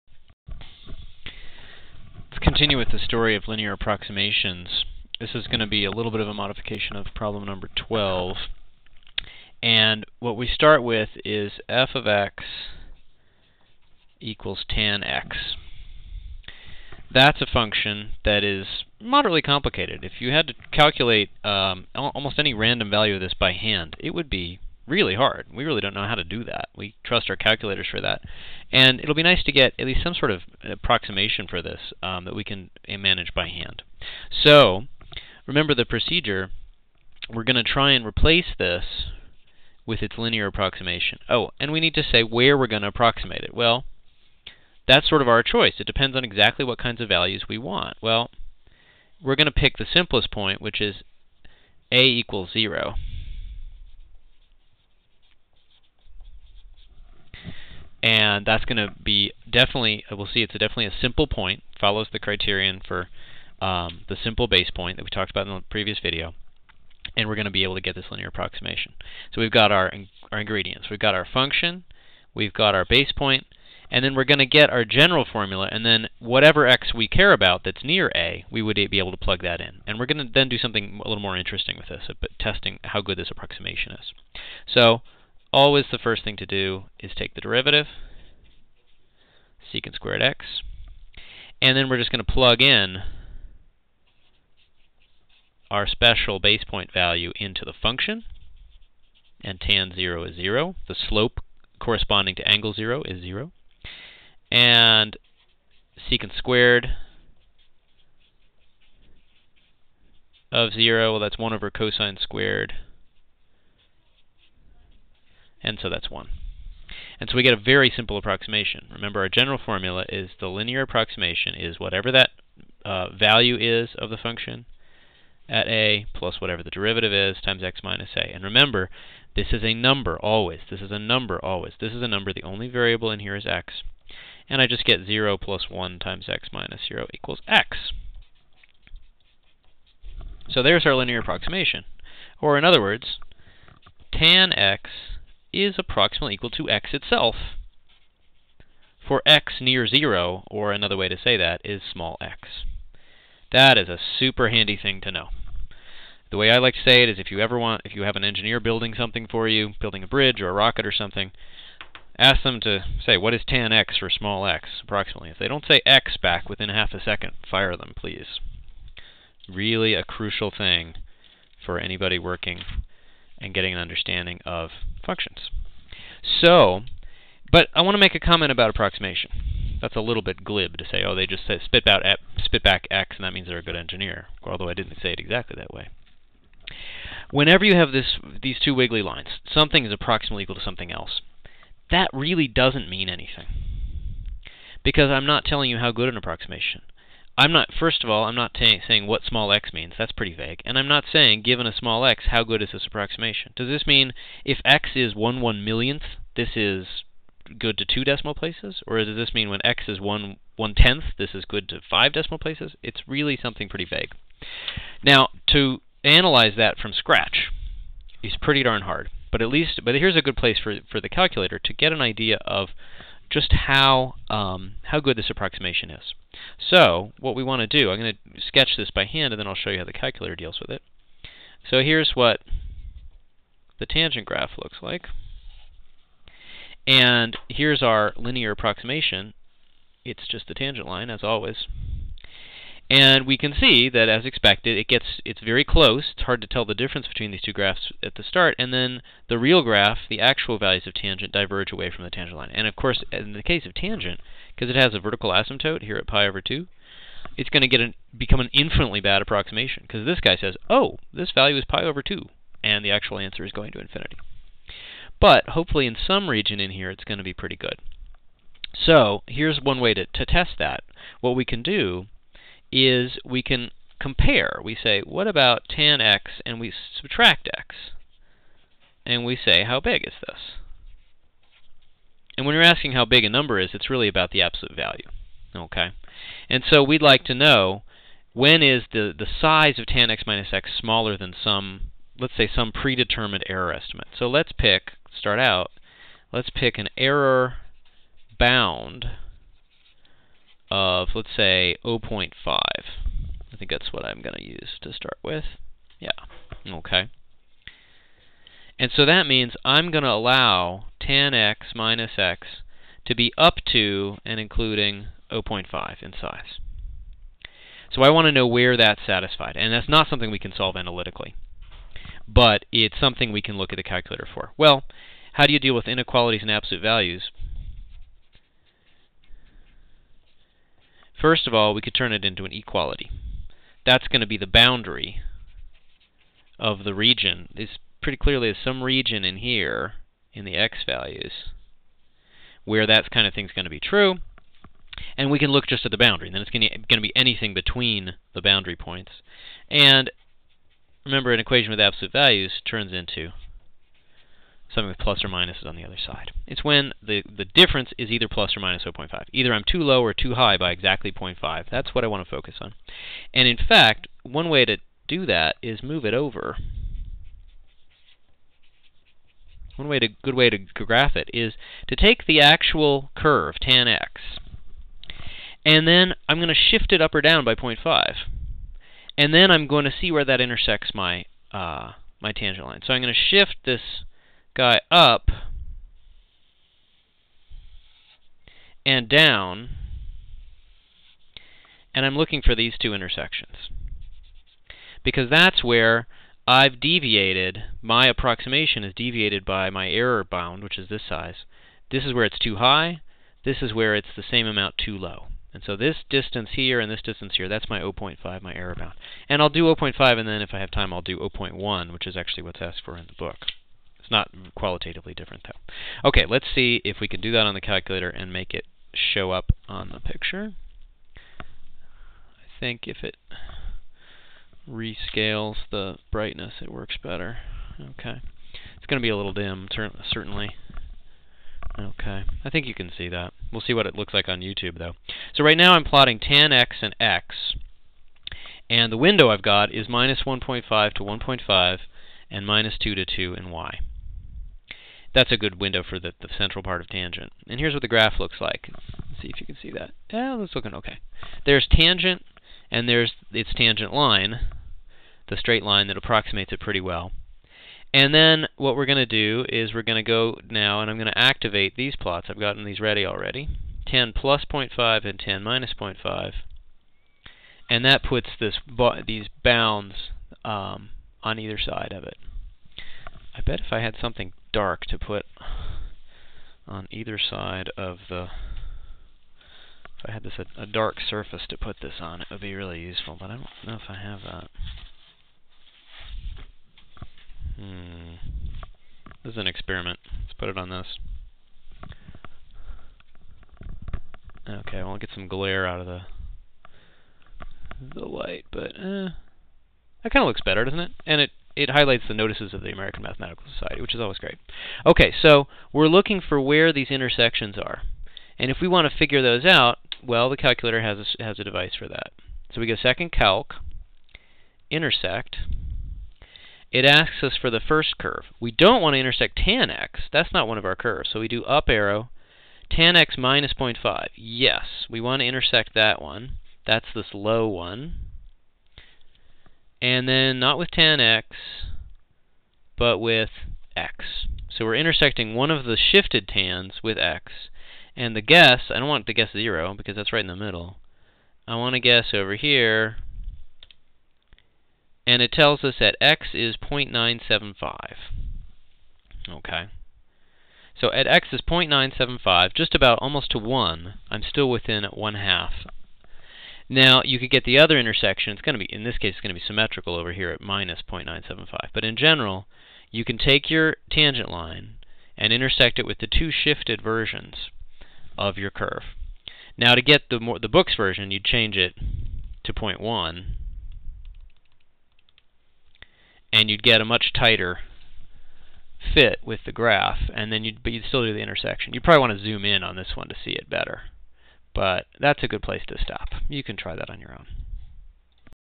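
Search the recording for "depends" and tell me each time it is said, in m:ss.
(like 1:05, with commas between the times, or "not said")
0:45.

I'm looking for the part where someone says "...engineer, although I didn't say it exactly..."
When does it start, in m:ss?
3:03.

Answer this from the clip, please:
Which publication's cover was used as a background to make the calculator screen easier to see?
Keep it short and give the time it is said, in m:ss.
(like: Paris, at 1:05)
Notices of the American Mathematical Society, at 8:22.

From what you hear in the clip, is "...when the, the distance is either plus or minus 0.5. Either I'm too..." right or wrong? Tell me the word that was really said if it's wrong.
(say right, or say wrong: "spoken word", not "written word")
wrong: "difference", not "distance".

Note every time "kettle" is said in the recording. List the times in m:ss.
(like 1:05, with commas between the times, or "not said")
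not said.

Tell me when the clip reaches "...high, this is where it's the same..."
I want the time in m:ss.
6:42.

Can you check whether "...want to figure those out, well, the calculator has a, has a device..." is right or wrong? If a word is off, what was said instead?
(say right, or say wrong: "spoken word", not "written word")
right.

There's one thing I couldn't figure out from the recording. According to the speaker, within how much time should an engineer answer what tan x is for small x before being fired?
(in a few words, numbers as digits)
half a second.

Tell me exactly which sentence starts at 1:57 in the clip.
And so we get a very simple approximation.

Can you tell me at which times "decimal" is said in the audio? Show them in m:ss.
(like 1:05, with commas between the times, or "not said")
3:28, 3:32.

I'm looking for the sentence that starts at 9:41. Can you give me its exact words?
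You would probably want to zoom in on this one to see it better.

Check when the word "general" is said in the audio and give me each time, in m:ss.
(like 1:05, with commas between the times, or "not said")
1:14, 1:59, 9:21.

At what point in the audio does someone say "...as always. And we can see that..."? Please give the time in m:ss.
4:01.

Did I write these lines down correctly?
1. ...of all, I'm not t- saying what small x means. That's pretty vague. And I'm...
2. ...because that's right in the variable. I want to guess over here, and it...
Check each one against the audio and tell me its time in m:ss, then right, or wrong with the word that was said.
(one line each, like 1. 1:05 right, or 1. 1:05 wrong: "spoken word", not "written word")
1. 3:18 right
2. 8:59 wrong: "middle", not "variable".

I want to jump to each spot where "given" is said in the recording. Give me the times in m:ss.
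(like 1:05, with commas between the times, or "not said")
3:21.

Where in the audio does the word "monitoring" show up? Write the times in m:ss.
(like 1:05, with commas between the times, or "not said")
not said.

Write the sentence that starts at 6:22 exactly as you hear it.
So I'm going to shift this guy up and down, and I'm looking for these two intersections.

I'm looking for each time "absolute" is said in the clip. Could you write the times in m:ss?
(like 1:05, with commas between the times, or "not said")
4:44, 5:26, 5:51.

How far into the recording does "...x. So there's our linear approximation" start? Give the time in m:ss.
2:17.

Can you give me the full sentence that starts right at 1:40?
The slope corresponding to angle 0 is 0.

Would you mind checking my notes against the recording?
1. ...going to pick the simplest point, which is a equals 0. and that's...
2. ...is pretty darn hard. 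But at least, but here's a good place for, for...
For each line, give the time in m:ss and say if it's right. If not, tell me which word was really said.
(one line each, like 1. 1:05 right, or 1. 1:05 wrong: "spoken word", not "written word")
1. 0:49 right
2. 3:38 right.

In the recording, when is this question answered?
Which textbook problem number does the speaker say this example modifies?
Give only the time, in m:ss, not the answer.
0:07.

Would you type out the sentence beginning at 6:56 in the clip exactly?
Okay, let's see if we can do that on the calculator and make it show up on the picture.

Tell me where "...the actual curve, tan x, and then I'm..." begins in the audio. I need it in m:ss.
6:12.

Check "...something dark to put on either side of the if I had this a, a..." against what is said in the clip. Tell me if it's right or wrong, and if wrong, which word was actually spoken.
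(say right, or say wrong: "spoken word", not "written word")
right.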